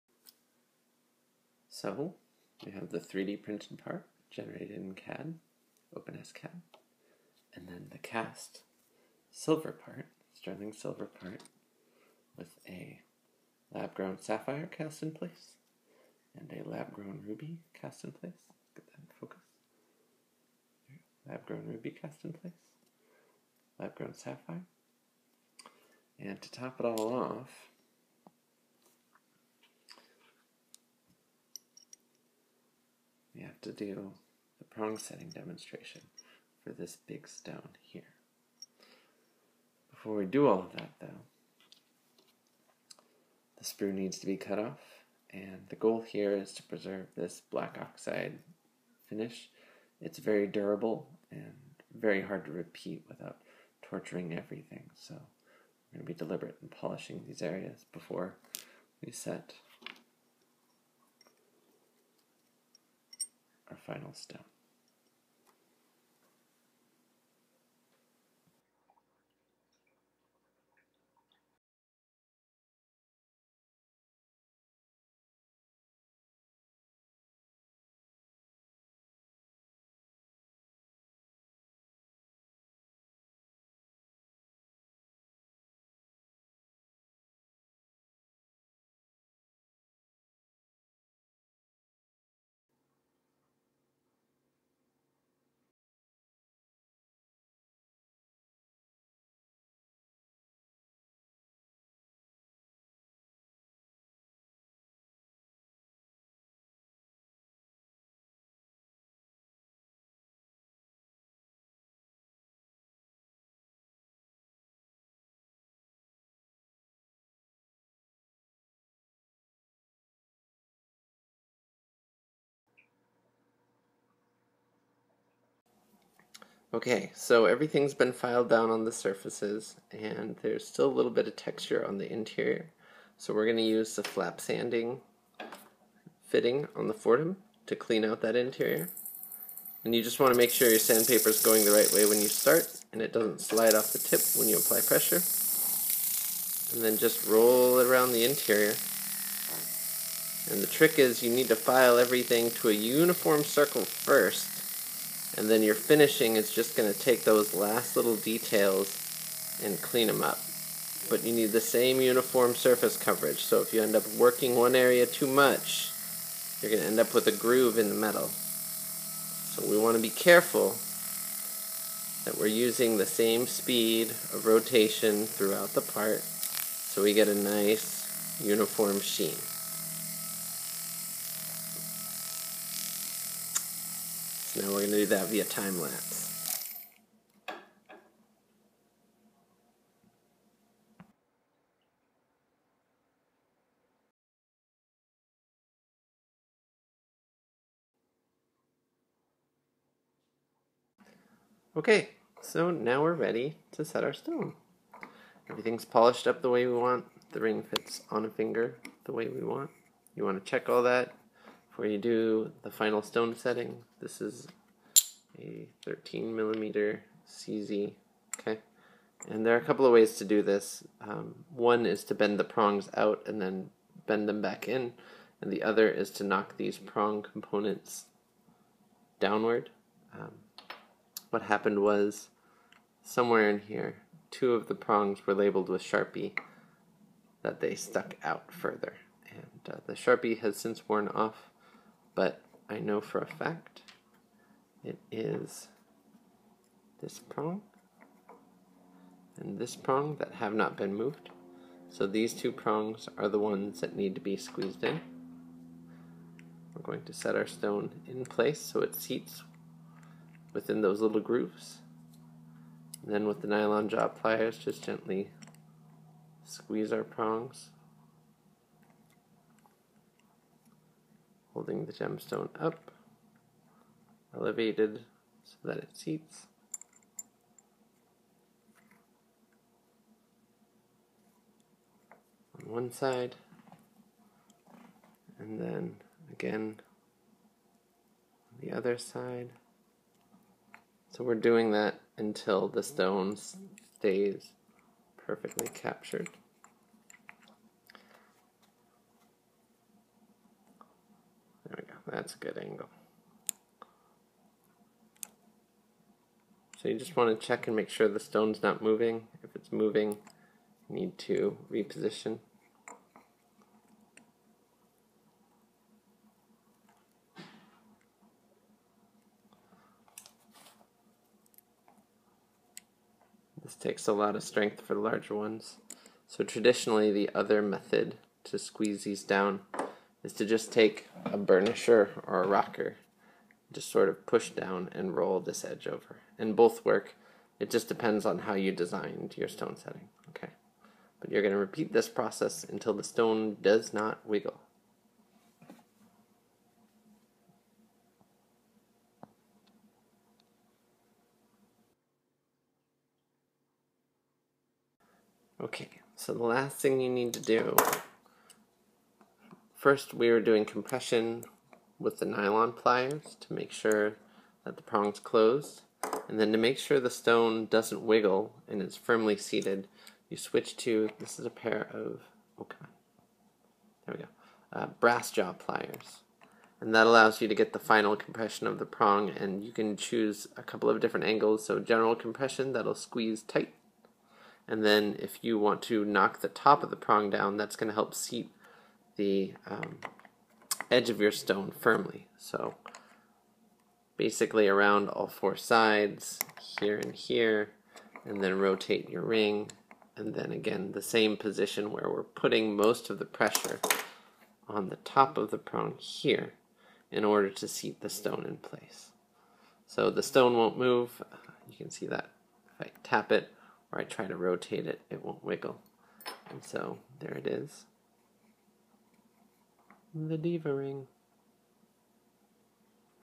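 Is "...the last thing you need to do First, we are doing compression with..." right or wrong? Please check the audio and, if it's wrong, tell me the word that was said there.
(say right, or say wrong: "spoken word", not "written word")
right.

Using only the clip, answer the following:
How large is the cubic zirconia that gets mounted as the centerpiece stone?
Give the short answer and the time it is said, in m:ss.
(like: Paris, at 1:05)
13 millimeters, at 3:35.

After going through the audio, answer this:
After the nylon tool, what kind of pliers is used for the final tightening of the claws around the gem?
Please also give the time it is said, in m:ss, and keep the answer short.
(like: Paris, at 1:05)
Brass jaw pliers, at 6:14.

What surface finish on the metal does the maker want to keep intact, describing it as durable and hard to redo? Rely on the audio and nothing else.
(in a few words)
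Black oxide.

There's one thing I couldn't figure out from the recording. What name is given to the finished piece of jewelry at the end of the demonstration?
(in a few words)
The Diva Ring.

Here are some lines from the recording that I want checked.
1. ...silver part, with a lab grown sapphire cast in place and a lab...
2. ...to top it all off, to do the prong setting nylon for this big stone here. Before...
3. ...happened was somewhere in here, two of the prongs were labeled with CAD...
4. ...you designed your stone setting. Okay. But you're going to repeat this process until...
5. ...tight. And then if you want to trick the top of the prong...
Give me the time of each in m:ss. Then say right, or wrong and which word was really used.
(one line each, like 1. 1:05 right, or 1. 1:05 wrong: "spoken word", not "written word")
1. 0:10 right
2. 0:26 wrong: "demonstration", not "nylon"
3. 3:51 wrong: "Sharpie", not "CAD"
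4. 5:38 right
5. 6:23 wrong: "knock", not "trick".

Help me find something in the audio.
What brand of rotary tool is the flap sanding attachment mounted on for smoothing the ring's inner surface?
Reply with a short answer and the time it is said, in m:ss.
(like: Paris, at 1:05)
Foredom, at 2:16.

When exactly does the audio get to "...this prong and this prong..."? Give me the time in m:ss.
4:07.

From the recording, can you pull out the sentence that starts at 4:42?
On one side, and then again on the other side.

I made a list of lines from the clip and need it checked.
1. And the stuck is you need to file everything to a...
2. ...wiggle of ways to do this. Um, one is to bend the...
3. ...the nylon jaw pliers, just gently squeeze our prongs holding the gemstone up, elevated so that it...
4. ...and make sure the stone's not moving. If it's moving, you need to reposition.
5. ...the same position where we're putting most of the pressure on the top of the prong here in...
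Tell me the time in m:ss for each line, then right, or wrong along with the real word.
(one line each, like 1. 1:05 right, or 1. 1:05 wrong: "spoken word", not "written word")
1. 2:30 wrong: "trick", not "stuck"
2. 3:39 wrong: "couple", not "wiggle"
3. 4:23 right
4. 5:07 right
5. 6:40 right.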